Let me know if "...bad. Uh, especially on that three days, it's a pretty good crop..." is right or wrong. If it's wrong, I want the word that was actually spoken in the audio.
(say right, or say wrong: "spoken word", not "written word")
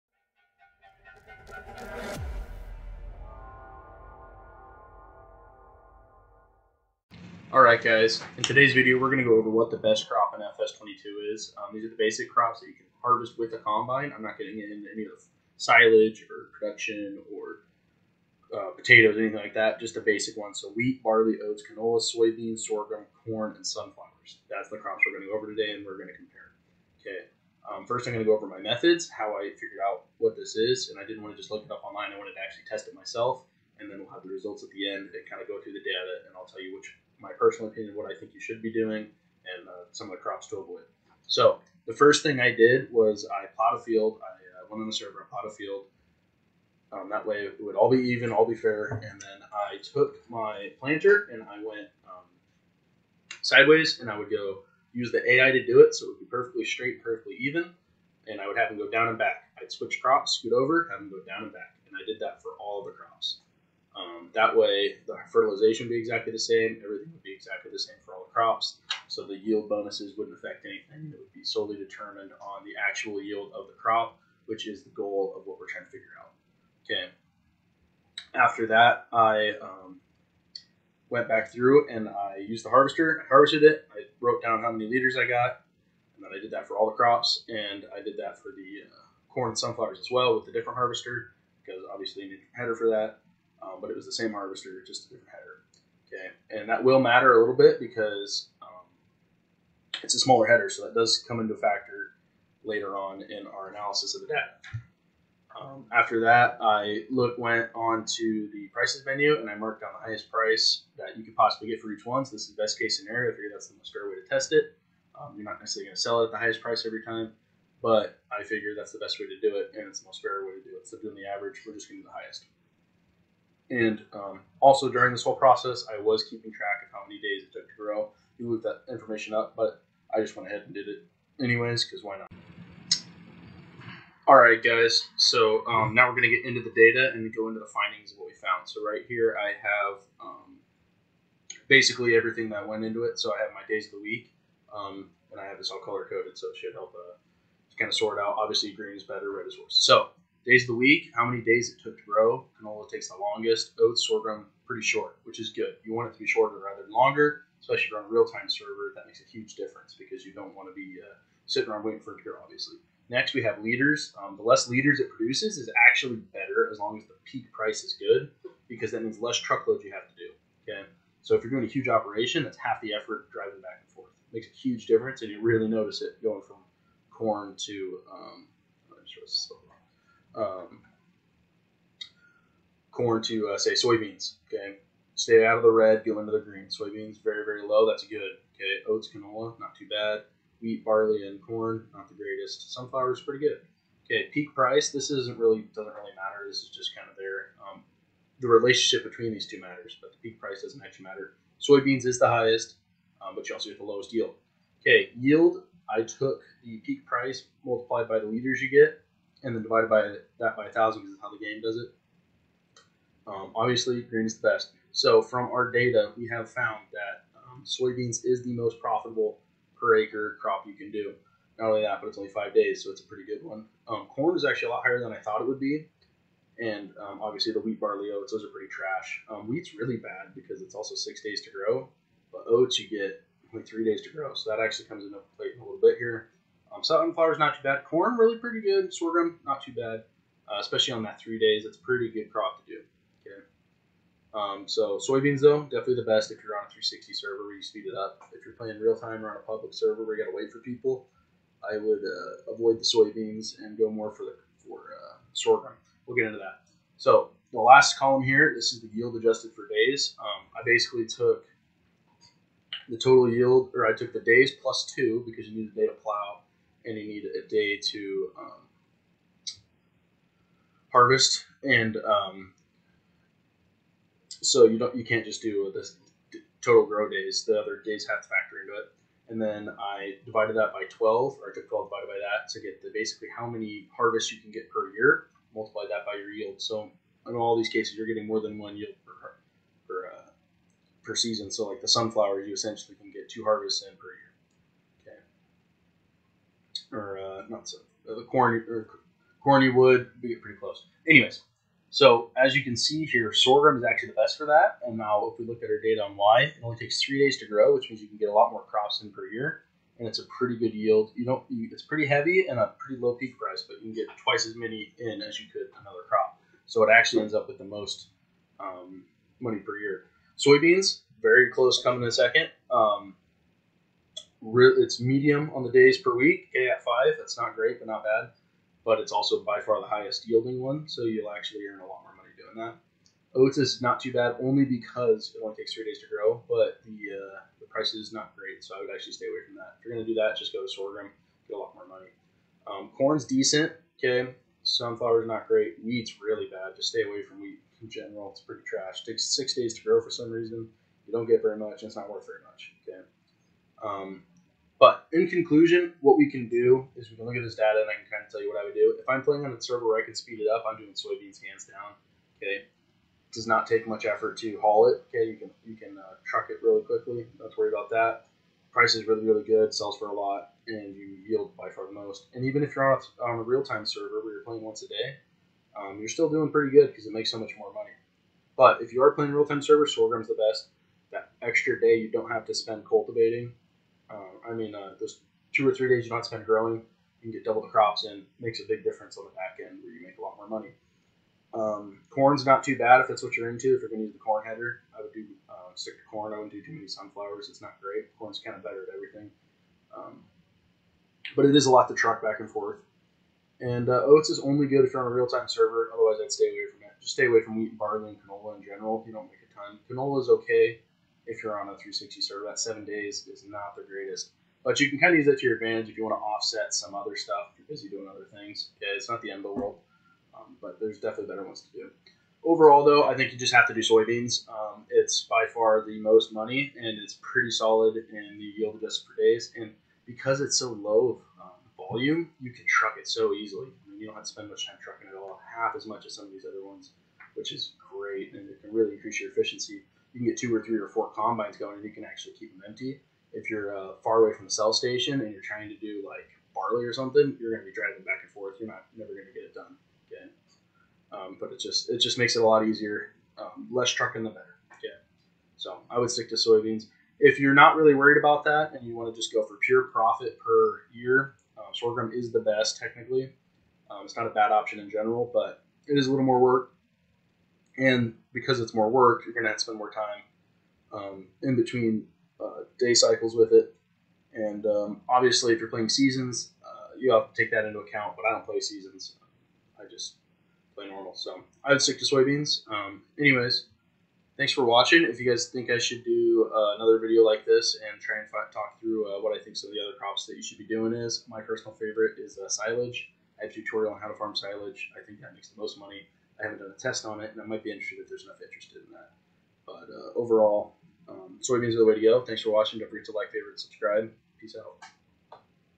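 right.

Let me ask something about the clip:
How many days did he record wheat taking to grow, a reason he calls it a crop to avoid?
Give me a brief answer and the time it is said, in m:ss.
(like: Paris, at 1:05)
6, at 5:49.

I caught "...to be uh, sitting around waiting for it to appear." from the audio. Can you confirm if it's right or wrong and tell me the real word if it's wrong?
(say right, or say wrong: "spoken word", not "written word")
right.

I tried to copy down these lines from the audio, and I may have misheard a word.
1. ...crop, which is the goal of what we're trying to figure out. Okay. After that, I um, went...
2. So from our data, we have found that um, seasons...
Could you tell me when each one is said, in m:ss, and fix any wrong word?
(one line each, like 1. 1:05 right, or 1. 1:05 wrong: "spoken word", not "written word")
1. 1:13 right
2. 3:34 wrong: "soybeans", not "seasons".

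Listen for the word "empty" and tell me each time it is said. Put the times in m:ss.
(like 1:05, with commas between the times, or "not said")
7:22.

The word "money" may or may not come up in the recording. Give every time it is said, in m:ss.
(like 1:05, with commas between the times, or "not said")
5:19, 5:32, 5:41, 6:17, 6:30, 7:06, 8:15.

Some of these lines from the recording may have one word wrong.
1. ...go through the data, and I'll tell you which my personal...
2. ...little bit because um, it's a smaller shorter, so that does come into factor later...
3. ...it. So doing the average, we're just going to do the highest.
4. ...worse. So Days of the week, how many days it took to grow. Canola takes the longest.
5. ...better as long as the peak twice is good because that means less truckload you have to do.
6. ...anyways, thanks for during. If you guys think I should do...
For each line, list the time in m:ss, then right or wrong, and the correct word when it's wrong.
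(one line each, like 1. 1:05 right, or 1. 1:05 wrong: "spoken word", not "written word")
1. 0:35 right
2. 1:37 wrong: "header", not "shorter"
3. 2:00 right
4. 2:29 right
5. 2:46 wrong: "price", not "twice"
6. 8:03 wrong: "watching", not "during".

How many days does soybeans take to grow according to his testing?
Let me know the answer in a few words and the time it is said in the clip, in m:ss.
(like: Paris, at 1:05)
5, at 3:42.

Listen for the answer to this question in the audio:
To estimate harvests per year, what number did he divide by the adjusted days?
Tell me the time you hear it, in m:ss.
4:41.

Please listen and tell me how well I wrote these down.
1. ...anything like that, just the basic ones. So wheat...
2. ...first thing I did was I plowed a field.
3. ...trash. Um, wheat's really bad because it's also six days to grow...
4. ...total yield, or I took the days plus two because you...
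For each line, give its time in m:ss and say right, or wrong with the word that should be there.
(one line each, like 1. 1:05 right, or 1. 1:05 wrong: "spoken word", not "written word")
1. 0:19 right
2. 0:41 right
3. 3:48 right
4. 4:22 right.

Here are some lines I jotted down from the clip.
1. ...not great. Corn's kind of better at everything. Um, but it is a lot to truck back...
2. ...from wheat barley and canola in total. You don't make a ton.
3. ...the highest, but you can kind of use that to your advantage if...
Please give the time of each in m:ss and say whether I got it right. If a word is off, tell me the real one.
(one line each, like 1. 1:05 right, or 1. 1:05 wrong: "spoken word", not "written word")
1. 6:37 right
2. 6:47 wrong: "general", not "total"
3. 6:53 wrong: "greatest", not "highest".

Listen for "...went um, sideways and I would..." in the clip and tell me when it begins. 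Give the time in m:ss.
0:51.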